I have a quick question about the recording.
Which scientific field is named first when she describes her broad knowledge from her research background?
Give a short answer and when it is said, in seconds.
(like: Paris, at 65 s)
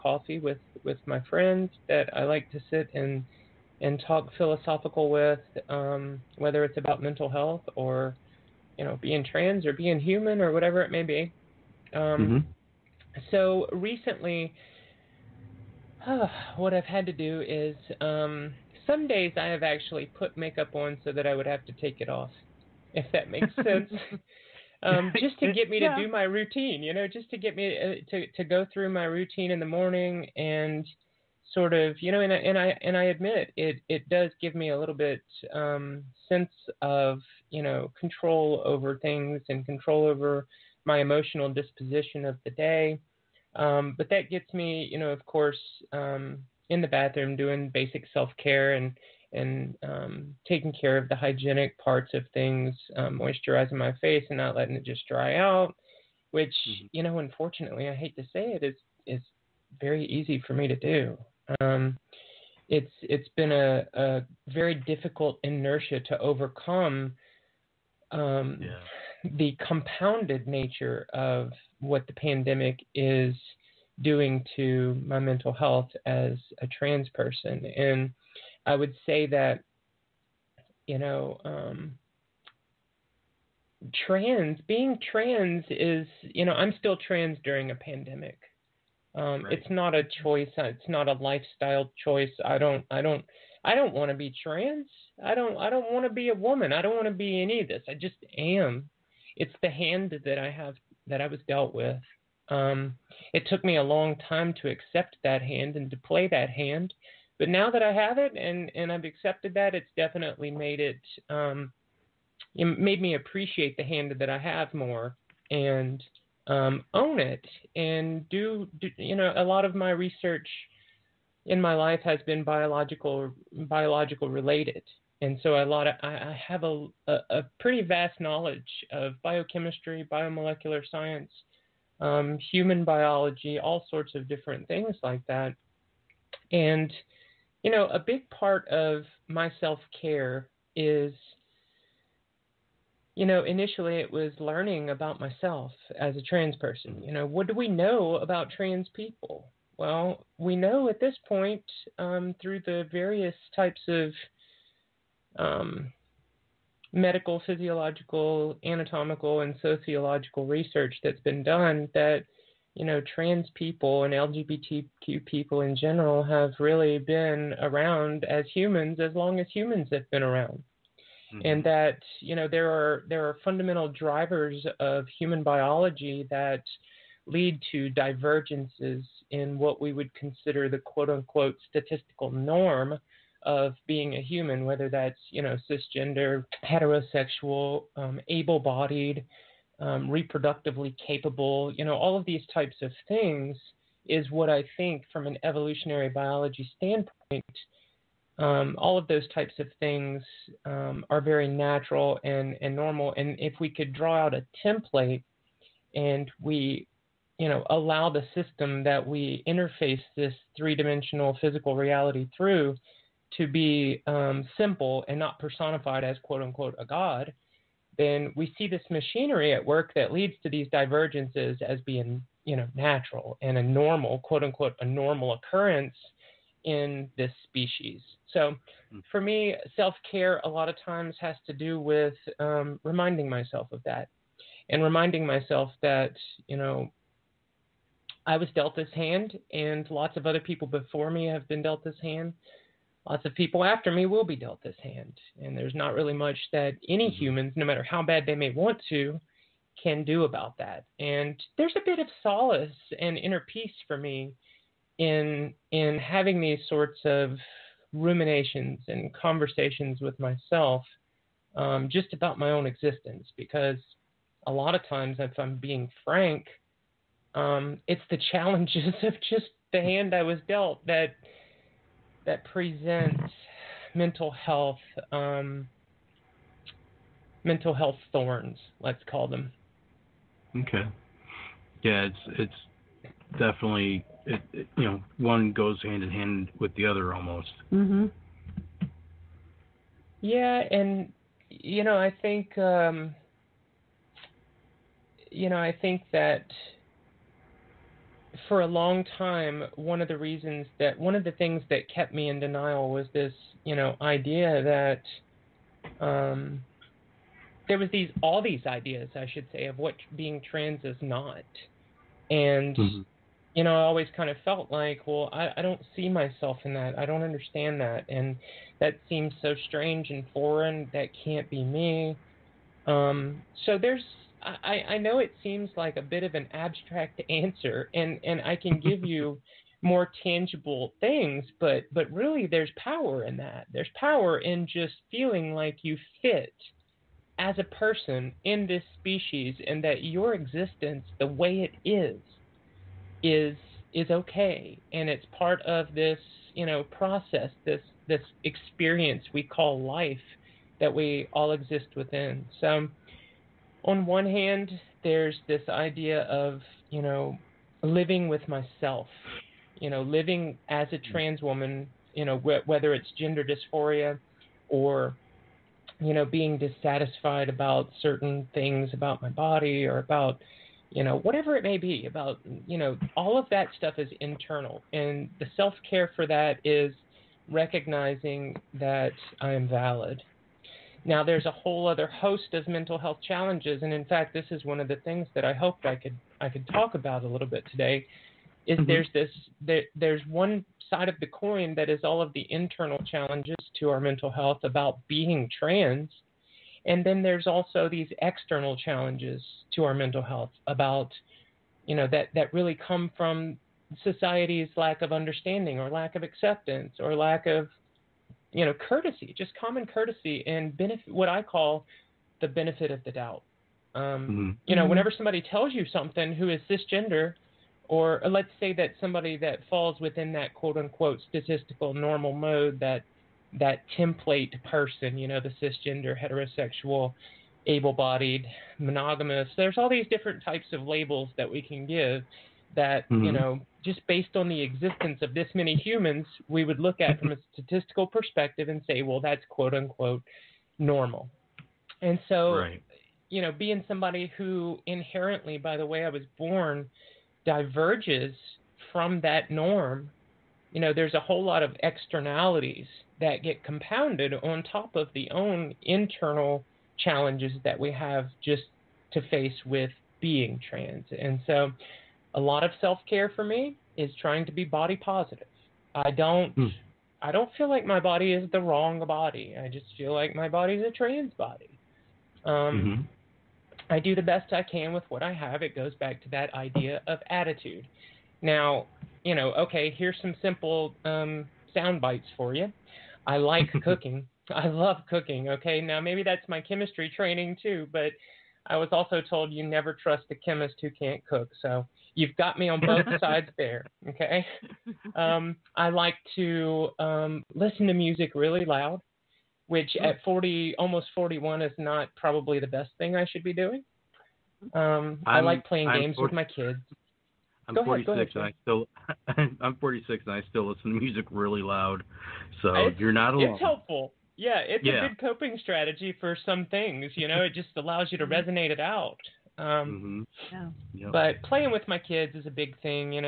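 biochemistry, at 129 s.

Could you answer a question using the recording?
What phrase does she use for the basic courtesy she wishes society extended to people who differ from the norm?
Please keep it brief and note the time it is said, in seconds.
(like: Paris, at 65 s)
benefit of the doubt, at 412 s.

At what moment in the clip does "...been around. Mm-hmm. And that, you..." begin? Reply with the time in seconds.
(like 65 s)
170 s.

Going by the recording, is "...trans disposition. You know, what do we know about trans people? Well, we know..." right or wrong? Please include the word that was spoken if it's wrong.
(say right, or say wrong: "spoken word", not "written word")
wrong: "person", not "disposition".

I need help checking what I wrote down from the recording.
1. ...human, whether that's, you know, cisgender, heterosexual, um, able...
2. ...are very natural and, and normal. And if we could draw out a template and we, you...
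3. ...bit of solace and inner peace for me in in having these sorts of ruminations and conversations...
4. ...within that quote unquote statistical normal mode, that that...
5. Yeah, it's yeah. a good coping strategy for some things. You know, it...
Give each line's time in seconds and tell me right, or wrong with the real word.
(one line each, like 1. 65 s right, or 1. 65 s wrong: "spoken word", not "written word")
1. 184 s right
2. 201 s right
3. 251 s right
4. 419 s right
5. 514 s right.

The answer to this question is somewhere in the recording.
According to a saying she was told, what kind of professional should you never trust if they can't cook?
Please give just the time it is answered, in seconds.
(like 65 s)
490 s.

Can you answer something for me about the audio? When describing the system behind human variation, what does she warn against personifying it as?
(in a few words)
a god.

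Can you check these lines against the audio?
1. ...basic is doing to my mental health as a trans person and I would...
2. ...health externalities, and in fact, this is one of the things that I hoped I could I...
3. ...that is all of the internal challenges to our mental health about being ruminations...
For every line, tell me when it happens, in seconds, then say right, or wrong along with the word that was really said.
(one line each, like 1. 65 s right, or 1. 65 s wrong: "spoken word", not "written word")
1. 72 s wrong: "pandemic", not "basic"
2. 382 s wrong: "challenges", not "externalities"
3. 391 s wrong: "trans", not "ruminations".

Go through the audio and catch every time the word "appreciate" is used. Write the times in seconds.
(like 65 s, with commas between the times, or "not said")
113 s.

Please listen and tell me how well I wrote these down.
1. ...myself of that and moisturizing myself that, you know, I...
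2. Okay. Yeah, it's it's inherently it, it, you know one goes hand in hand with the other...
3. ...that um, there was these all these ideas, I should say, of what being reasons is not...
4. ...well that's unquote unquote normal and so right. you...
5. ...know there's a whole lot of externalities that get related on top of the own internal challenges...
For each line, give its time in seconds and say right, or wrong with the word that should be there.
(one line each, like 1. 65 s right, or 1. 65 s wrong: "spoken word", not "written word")
1. 233 s wrong: "reminding", not "moisturizing"
2. 280 s wrong: "definitely", not "inherently"
3. 304 s wrong: "trans", not "reasons"
4. 439 s wrong: "quote", not "unquote"
5. 450 s wrong: "compounded", not "related".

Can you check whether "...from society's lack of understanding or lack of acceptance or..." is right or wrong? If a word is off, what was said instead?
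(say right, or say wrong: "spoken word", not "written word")
right.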